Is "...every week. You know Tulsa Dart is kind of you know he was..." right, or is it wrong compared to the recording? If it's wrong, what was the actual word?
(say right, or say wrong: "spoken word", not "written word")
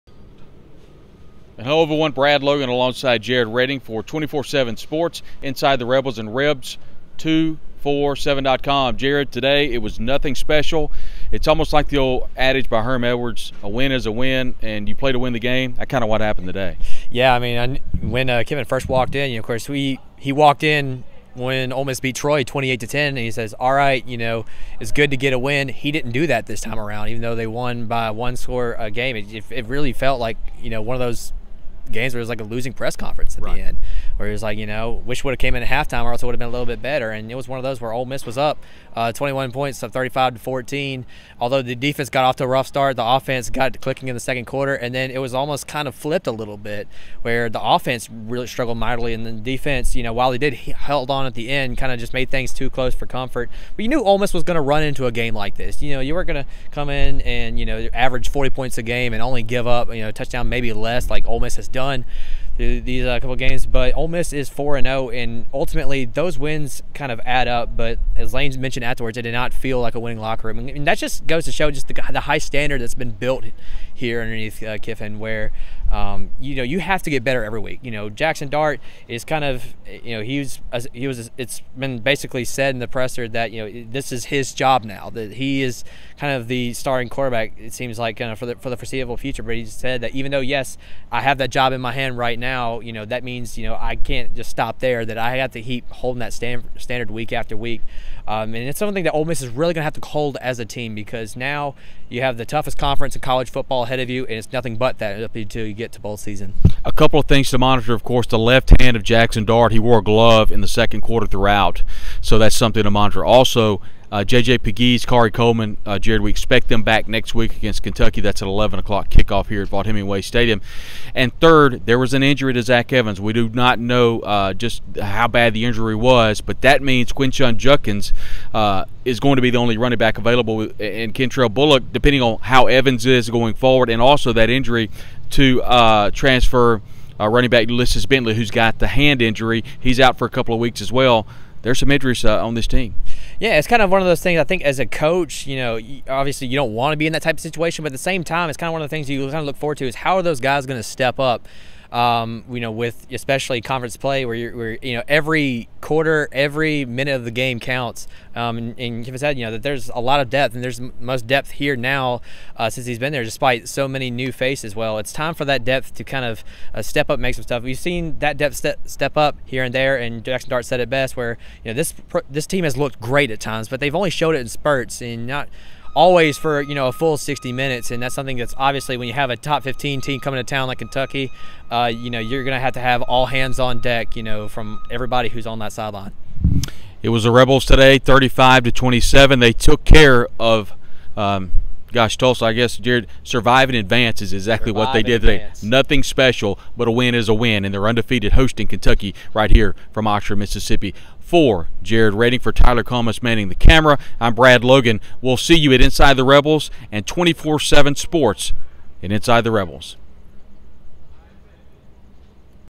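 wrong: "Jackson", not "Tulsa".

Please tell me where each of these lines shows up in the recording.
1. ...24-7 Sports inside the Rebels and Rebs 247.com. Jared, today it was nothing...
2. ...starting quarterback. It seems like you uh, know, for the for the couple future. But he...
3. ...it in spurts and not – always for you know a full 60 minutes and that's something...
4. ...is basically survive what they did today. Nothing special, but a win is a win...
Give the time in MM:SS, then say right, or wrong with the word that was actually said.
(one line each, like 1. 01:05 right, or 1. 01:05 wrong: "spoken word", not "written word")
1. 00:04 right
2. 01:26 wrong: "foreseeable", not "couple"
3. 02:54 right
4. 03:14 wrong: "exactly", not "basically".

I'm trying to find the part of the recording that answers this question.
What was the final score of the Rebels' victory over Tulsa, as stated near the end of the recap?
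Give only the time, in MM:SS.
03:07.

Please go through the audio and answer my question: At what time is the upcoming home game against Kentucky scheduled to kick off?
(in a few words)
11 o'clock.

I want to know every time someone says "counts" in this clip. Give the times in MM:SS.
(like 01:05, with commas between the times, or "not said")
02:37.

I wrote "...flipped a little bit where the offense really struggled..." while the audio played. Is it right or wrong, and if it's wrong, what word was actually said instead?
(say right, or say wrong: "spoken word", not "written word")
right.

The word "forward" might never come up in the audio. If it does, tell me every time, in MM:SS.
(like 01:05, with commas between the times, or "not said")
02:13, 02:29.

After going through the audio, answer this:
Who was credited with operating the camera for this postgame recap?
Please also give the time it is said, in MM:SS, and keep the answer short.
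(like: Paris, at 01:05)
Tyler Comas, at 03:22.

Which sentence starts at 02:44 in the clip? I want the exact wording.
Well, it's time for that depth to kind of uh, step up, make some stuff.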